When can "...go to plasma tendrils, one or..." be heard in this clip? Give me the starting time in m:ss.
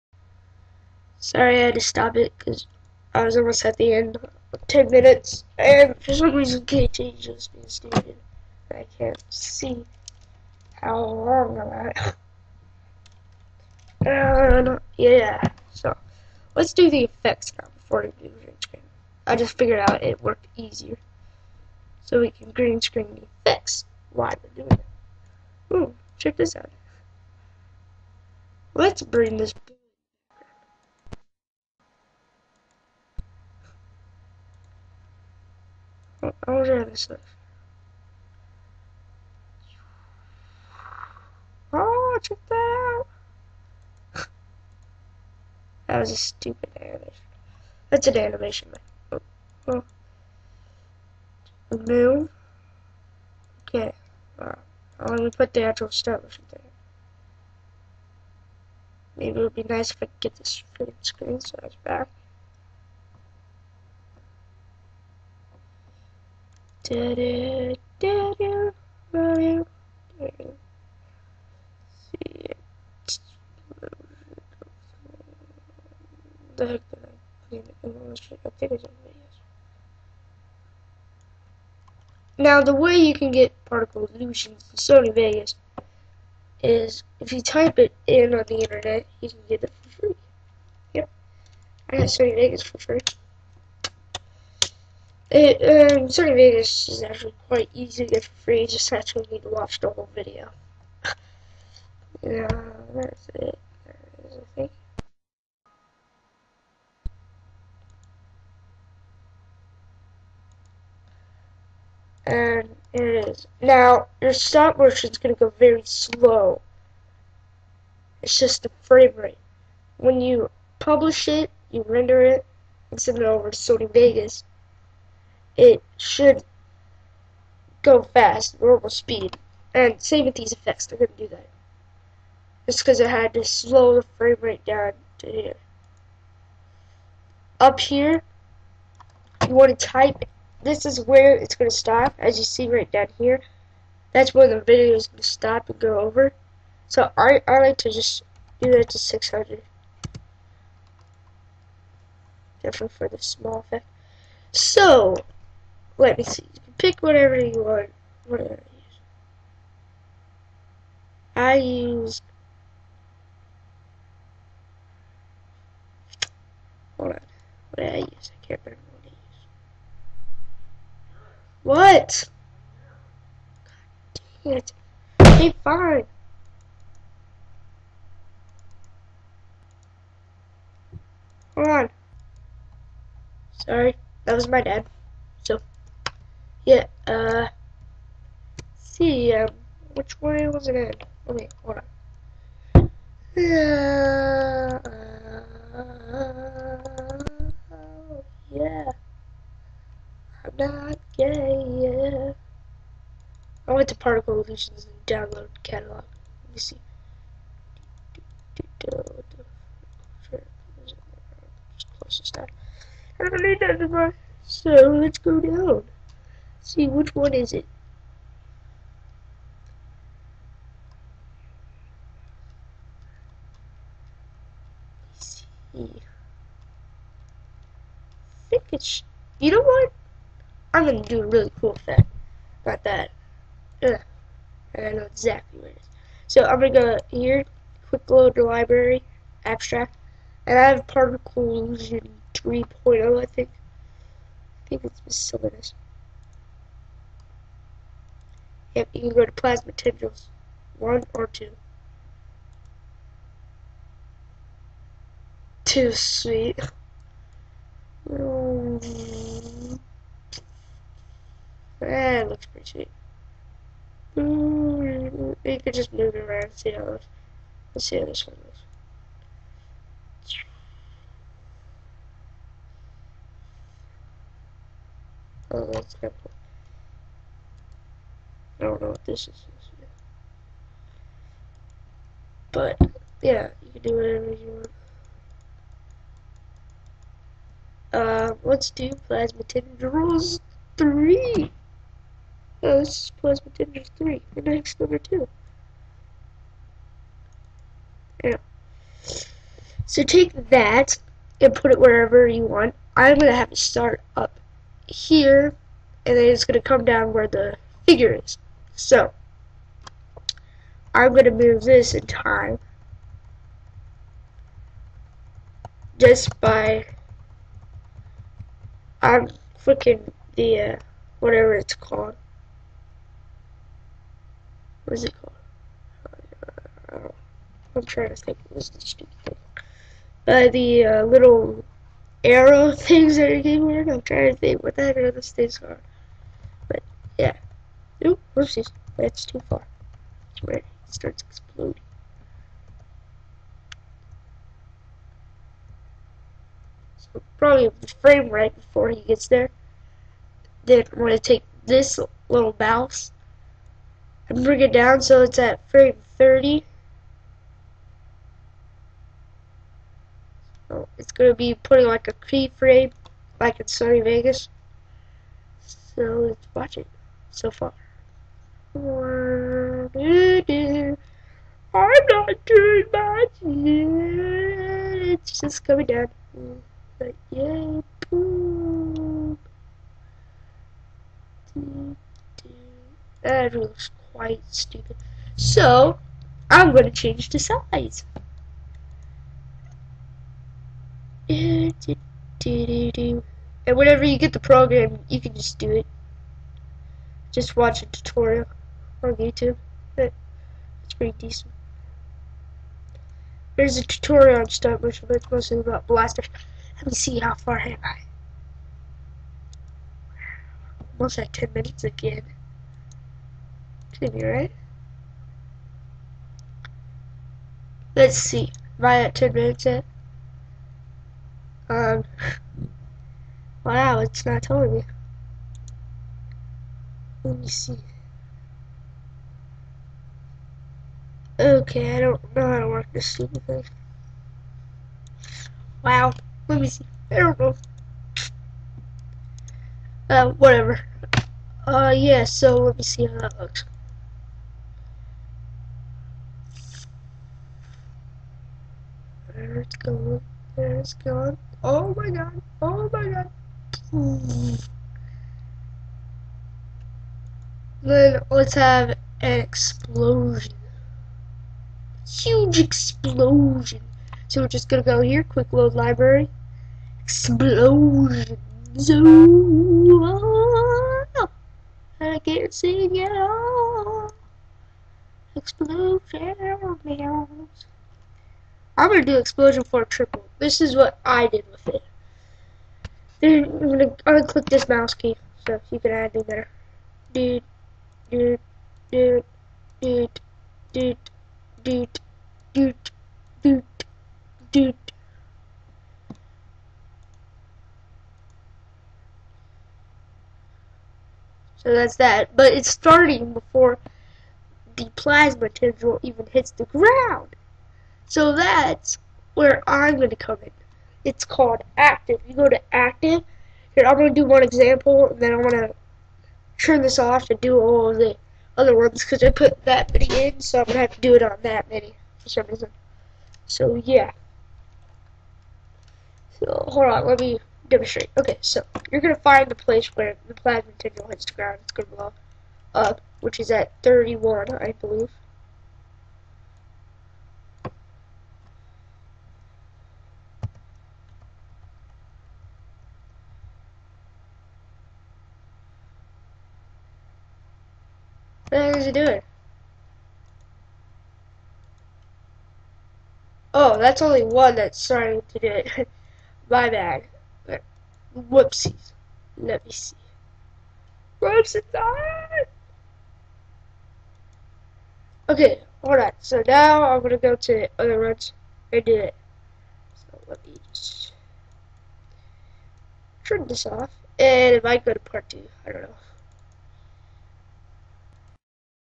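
4:09.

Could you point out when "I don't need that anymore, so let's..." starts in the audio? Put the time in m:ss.
3:33.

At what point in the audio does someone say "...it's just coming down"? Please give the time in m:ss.
6:15.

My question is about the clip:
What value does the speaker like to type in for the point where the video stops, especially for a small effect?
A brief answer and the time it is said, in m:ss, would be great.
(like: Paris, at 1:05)
600, at 2:28.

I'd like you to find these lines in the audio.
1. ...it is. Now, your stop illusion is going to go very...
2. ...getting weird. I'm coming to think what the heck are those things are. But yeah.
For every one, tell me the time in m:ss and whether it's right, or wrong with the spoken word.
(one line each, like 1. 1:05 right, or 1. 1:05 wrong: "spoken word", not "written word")
1. 1:52 wrong: "motion", not "illusion"
2. 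5:33 wrong: "trying", not "coming".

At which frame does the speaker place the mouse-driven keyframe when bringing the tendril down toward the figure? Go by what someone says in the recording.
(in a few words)
30.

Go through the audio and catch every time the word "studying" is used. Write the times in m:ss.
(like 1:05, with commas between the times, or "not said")
not said.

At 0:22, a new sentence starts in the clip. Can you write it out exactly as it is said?
So we can green screen the effects while we're doing it.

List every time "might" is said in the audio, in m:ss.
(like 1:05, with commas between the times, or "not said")
9:34.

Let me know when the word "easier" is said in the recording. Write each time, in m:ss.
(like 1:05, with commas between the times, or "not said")
0:20.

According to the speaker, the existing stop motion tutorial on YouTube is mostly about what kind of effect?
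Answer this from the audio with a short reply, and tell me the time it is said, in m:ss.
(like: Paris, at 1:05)
blasters, at 6:45.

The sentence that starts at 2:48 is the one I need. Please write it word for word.
I can't remember what I use.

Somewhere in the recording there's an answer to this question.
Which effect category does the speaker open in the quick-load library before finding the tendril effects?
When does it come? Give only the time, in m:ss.
3:59.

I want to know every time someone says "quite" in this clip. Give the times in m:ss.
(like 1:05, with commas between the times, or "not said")
1:37, 6:24.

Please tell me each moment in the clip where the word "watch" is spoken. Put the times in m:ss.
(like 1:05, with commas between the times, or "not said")
1:39, 6:06, 6:37.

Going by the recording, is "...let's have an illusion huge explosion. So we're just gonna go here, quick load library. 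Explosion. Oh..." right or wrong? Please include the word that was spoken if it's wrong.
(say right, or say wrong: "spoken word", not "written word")
wrong: "explosion", not "illusion".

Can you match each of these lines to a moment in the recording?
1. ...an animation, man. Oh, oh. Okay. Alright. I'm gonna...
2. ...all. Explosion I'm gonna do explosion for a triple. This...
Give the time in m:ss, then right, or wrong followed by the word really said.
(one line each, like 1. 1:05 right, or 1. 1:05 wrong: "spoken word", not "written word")
1. 0:48 right
2. 7:53 right.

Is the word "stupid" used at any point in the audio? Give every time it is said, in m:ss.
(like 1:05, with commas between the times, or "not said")
0:07, 0:46, 5:28, 6:24, 7:13.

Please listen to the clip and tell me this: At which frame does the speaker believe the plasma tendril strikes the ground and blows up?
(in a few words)
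31.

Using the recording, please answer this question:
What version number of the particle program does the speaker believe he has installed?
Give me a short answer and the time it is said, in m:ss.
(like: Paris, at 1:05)
3.0, at 4:00.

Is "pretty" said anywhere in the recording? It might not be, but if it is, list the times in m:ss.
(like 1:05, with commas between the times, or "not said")
4:22, 6:40.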